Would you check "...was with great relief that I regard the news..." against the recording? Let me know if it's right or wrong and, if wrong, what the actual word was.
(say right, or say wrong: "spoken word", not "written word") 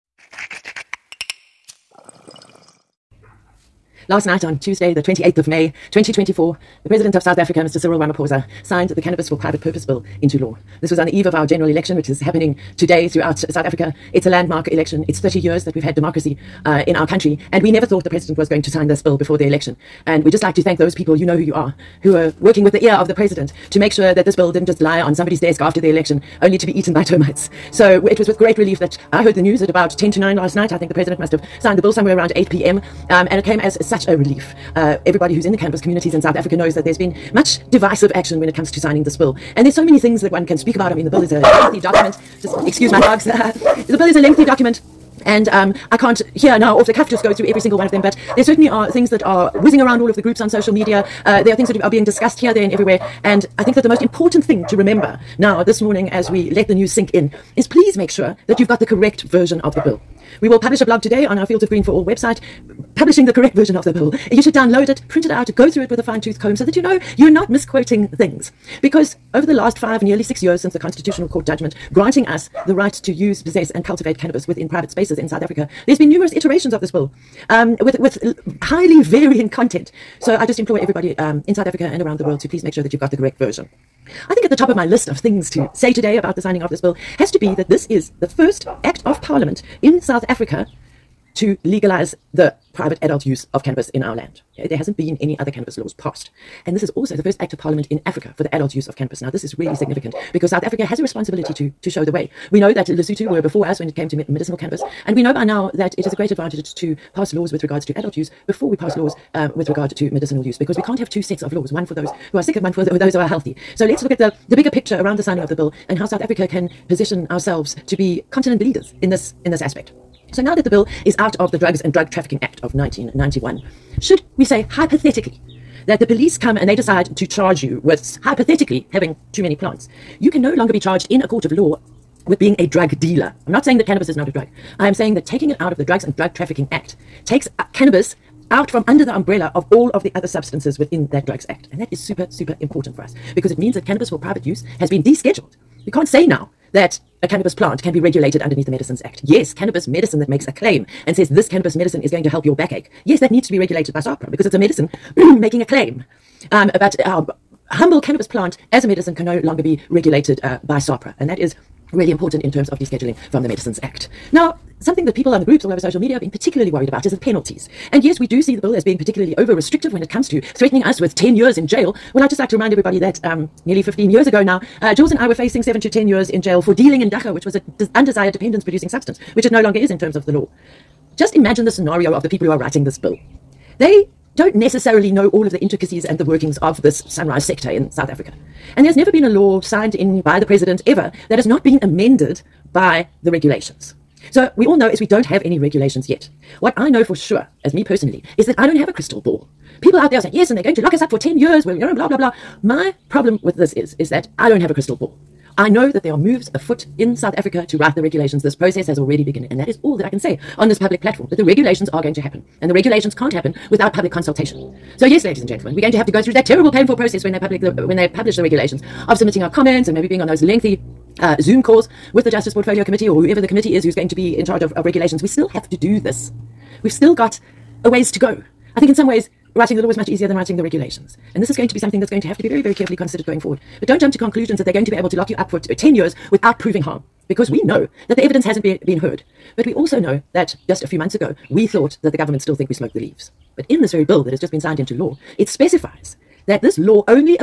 wrong: "heard", not "regard".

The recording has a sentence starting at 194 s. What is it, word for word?
So we all know is we don't have any regulations yet.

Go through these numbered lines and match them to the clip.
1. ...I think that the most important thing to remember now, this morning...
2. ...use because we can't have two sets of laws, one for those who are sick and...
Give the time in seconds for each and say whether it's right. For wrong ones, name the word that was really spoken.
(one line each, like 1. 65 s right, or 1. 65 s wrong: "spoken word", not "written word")
1. 53 s right
2. 110 s right.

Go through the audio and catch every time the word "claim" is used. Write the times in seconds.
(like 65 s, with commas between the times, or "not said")
150 s, 155 s.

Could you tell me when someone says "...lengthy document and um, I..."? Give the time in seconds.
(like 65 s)
44 s.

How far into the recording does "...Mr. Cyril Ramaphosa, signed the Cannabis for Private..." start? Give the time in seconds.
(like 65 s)
7 s.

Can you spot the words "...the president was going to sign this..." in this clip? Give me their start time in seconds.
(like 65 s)
18 s.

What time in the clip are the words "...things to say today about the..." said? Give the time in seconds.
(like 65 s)
85 s.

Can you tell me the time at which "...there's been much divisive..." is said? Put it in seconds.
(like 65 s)
36 s.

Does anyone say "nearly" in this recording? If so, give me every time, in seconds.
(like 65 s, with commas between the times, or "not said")
70 s, 173 s.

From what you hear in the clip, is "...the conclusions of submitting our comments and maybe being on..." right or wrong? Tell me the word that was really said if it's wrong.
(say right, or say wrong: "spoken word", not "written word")
wrong: "regulations", not "conclusions".